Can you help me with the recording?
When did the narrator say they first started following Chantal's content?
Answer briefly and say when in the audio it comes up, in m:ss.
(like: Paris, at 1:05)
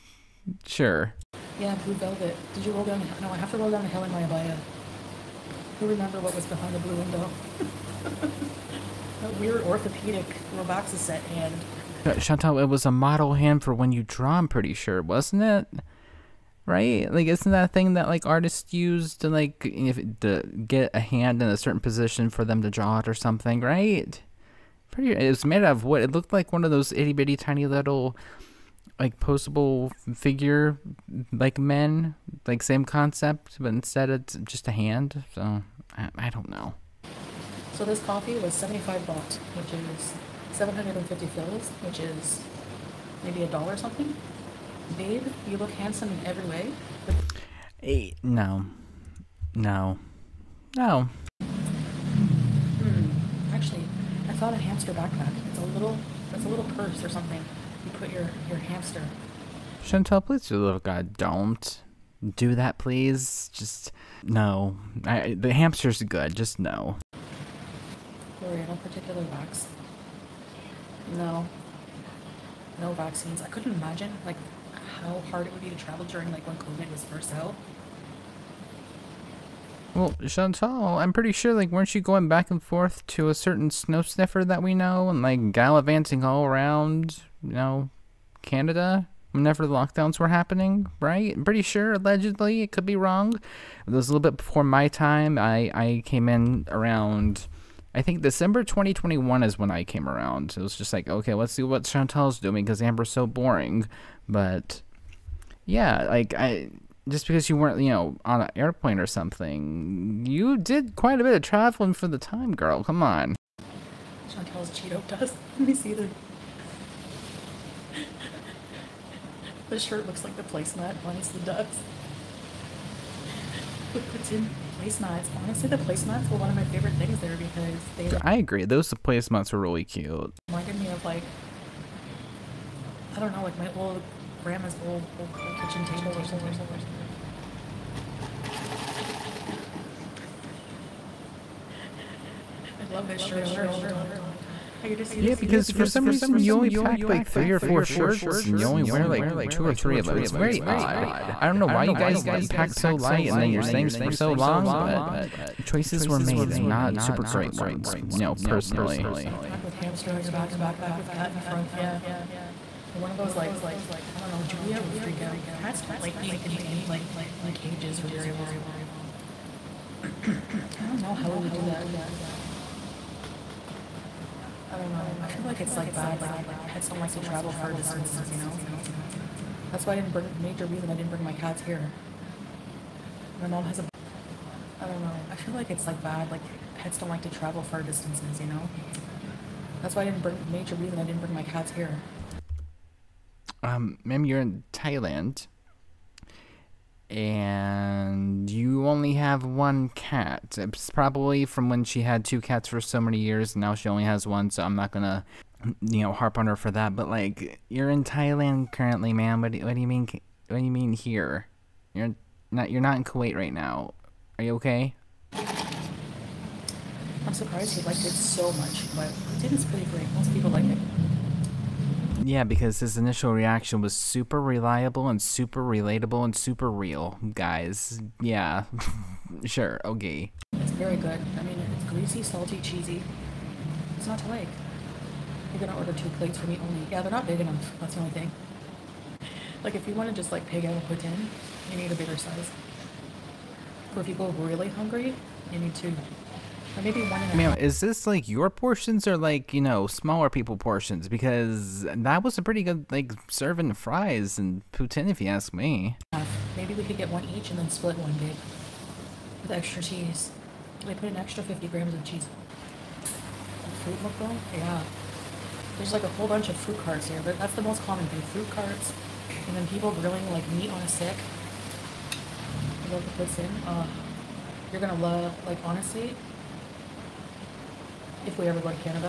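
December 2021, at 1:38.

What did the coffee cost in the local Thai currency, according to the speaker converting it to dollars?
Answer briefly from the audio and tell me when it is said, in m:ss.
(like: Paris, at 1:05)
75 baht, at 0:38.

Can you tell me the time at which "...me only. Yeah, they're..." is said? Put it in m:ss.
3:56.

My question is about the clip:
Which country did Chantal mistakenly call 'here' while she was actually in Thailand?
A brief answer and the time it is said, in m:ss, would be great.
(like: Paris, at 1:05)
Kuwait, at 3:33.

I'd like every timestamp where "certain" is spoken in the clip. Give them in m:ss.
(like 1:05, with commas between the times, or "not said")
0:21, 1:23.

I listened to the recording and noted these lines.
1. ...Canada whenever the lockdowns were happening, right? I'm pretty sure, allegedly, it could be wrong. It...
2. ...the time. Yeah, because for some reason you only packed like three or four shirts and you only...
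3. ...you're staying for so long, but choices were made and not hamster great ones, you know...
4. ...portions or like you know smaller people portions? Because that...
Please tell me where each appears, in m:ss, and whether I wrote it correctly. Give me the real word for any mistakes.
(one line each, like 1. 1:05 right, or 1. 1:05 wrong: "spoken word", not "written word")
1. 1:28 right
2. 2:23 right
3. 2:33 wrong: "super", not "hamster"
4. 4:08 right.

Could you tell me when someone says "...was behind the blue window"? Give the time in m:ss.
0:06.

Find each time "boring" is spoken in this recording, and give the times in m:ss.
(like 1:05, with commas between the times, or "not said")
1:43.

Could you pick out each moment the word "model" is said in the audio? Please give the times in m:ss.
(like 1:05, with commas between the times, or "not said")
0:12.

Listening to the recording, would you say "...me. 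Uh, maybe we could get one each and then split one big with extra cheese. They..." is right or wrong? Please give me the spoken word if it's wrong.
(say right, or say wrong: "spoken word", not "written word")
right.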